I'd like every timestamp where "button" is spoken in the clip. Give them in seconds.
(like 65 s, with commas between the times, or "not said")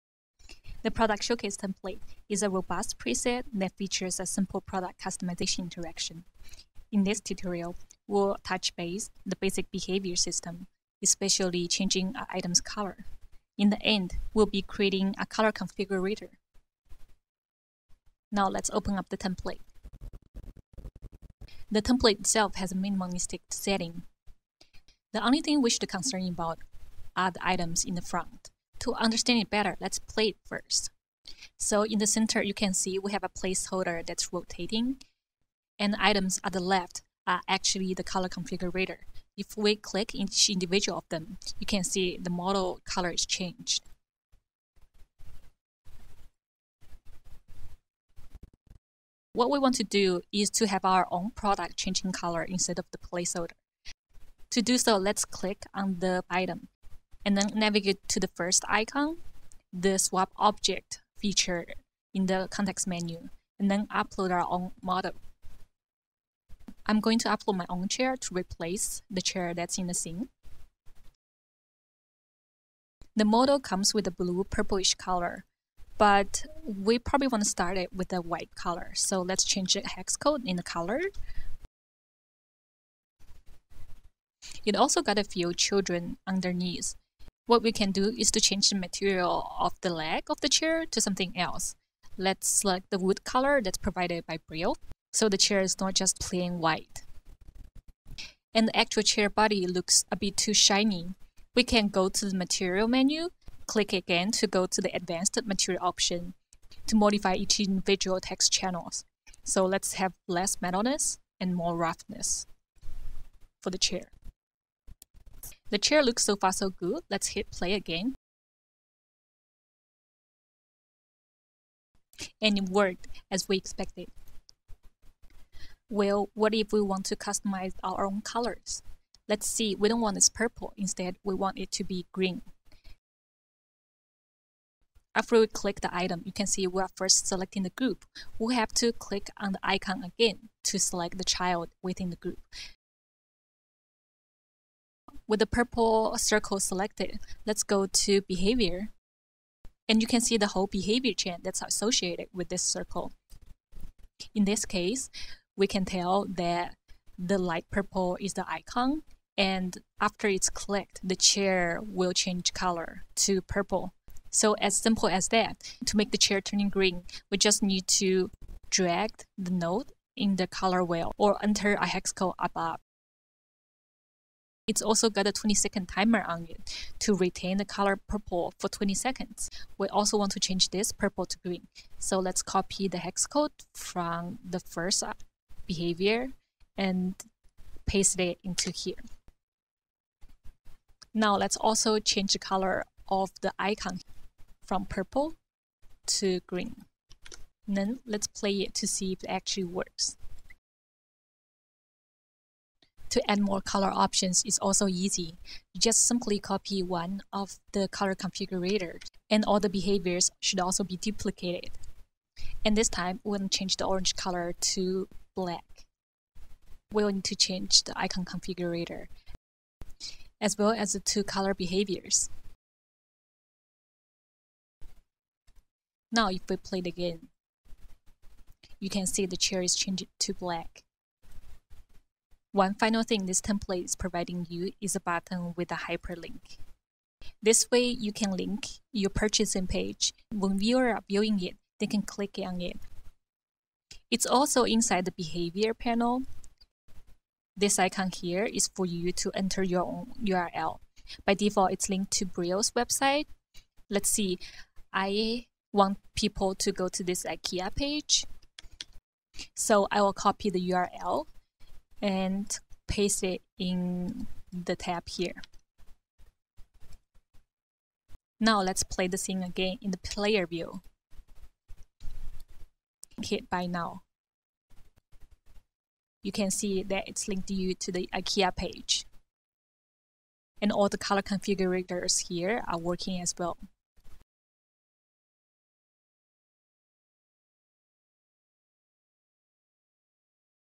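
234 s.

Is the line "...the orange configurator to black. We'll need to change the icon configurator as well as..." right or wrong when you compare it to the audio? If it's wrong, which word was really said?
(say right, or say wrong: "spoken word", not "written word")
wrong: "color", not "configurator".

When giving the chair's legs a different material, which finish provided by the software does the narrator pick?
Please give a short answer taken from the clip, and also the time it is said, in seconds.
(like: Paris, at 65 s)
wood, at 92 s.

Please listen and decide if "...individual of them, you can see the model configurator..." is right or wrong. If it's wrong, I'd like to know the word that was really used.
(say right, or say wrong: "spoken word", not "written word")
wrong: "color", not "configurator".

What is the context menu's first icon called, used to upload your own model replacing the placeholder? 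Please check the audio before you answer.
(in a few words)
swap object.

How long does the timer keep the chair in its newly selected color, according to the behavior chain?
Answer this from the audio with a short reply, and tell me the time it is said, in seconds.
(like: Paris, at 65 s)
20 seconds, at 175 s.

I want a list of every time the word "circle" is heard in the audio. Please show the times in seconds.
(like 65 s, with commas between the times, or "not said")
146 s, 152 s.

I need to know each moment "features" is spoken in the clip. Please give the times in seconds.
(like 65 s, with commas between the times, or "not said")
3 s, 61 s.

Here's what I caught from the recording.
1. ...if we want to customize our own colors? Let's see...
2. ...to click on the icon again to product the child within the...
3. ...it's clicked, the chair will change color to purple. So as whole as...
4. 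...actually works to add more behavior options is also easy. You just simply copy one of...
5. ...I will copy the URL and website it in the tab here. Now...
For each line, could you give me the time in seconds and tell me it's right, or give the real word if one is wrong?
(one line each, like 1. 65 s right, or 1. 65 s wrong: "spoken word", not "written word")
1. 126 s right
2. 138 s wrong: "select", not "product"
3. 160 s wrong: "simple", not "whole"
4. 199 s wrong: "color", not "behavior"
5. 259 s wrong: "paste", not "website".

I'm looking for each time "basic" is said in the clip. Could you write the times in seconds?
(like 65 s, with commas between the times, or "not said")
9 s.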